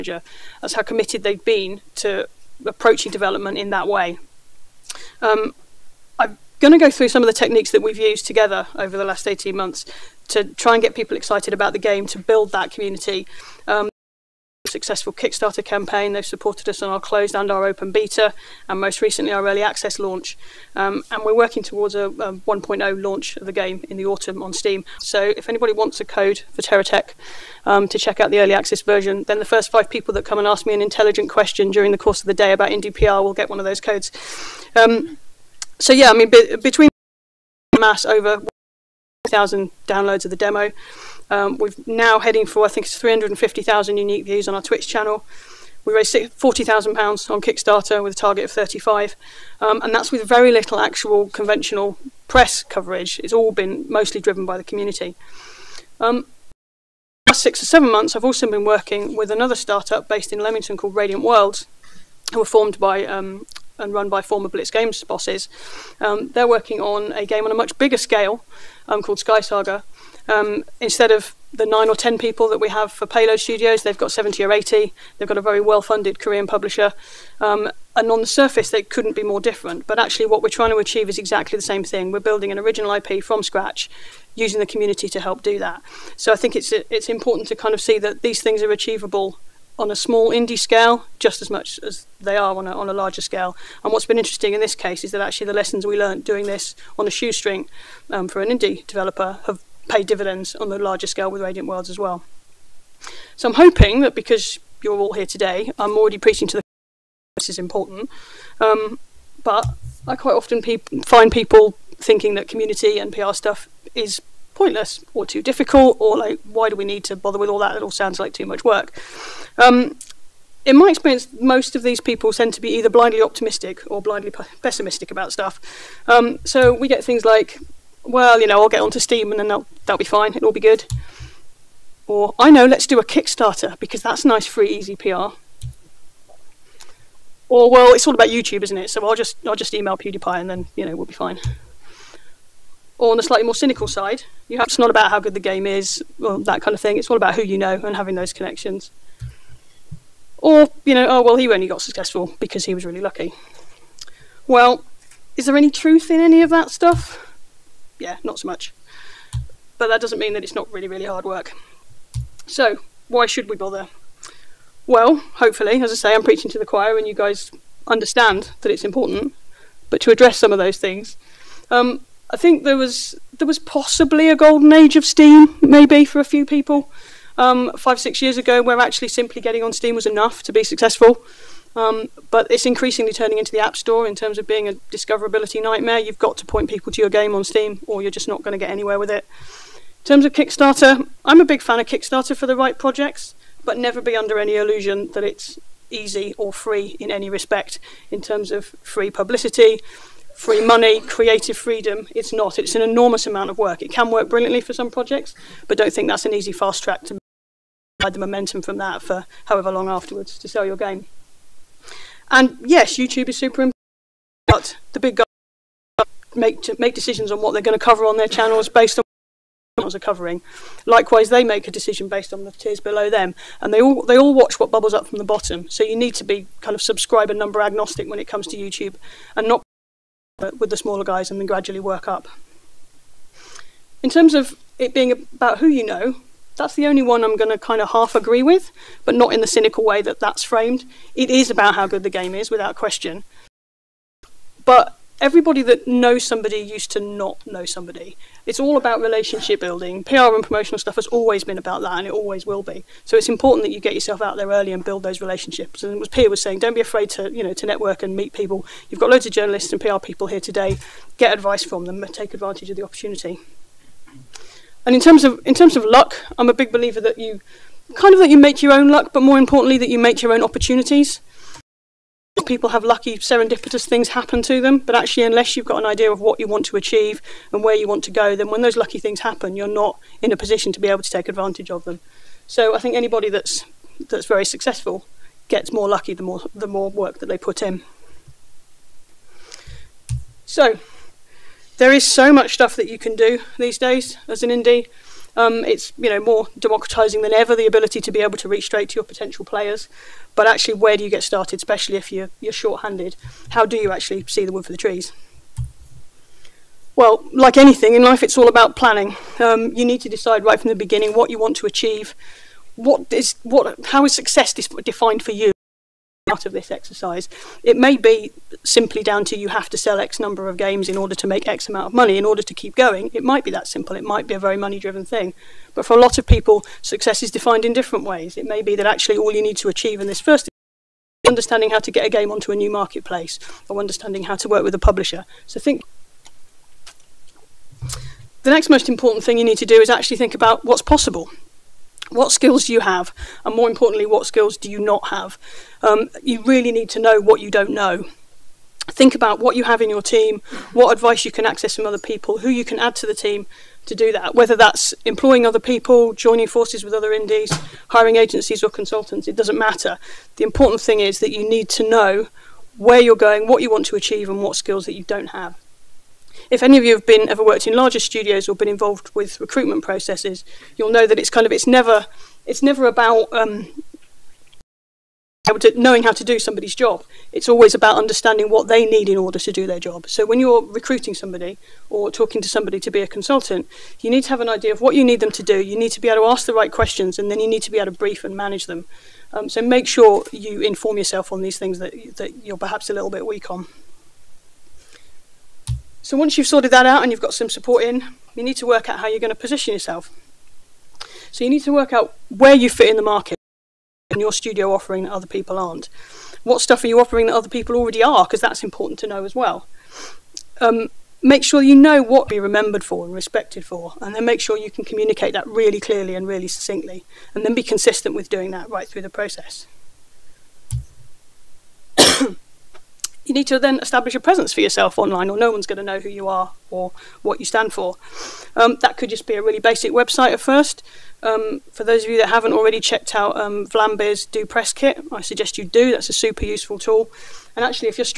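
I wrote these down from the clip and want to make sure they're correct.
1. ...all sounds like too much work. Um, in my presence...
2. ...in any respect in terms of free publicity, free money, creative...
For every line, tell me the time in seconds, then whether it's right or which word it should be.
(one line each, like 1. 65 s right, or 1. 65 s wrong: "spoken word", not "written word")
1. 117 s wrong: "experience", not "presence"
2. 196 s right.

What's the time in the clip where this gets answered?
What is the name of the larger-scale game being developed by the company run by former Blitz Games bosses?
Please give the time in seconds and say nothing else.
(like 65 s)
69 s.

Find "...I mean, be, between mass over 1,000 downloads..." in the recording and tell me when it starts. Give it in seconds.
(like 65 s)
36 s.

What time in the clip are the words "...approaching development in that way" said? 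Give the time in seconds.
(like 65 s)
2 s.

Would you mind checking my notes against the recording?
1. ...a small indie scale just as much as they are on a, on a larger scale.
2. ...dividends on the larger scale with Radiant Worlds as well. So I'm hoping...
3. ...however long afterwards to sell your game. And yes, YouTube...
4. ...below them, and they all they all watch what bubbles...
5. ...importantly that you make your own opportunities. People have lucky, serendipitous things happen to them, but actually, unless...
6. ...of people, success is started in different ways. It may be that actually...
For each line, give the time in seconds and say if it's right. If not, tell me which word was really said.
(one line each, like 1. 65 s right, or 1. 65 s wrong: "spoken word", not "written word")
1. 89 s right
2. 100 s right
3. 209 s right
4. 222 s right
5. 269 s right
6. 326 s wrong: "defined", not "started".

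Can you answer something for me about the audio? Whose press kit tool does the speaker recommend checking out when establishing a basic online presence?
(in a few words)
Vlambeer.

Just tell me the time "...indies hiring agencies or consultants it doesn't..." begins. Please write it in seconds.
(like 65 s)
357 s.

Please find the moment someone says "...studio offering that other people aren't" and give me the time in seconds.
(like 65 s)
404 s.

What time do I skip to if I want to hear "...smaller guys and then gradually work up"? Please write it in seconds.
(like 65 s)
230 s.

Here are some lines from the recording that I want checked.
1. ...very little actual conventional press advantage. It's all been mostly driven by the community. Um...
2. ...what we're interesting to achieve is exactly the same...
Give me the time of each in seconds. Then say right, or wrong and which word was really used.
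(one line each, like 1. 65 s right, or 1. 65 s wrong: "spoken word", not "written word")
1. 50 s wrong: "coverage", not "advantage"
2. 80 s wrong: "trying", not "interesting".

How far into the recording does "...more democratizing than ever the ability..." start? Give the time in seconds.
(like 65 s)
296 s.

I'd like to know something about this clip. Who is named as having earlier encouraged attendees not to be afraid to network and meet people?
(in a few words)
Pierre.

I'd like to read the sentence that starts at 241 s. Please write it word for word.
It is about how good the game is, without question.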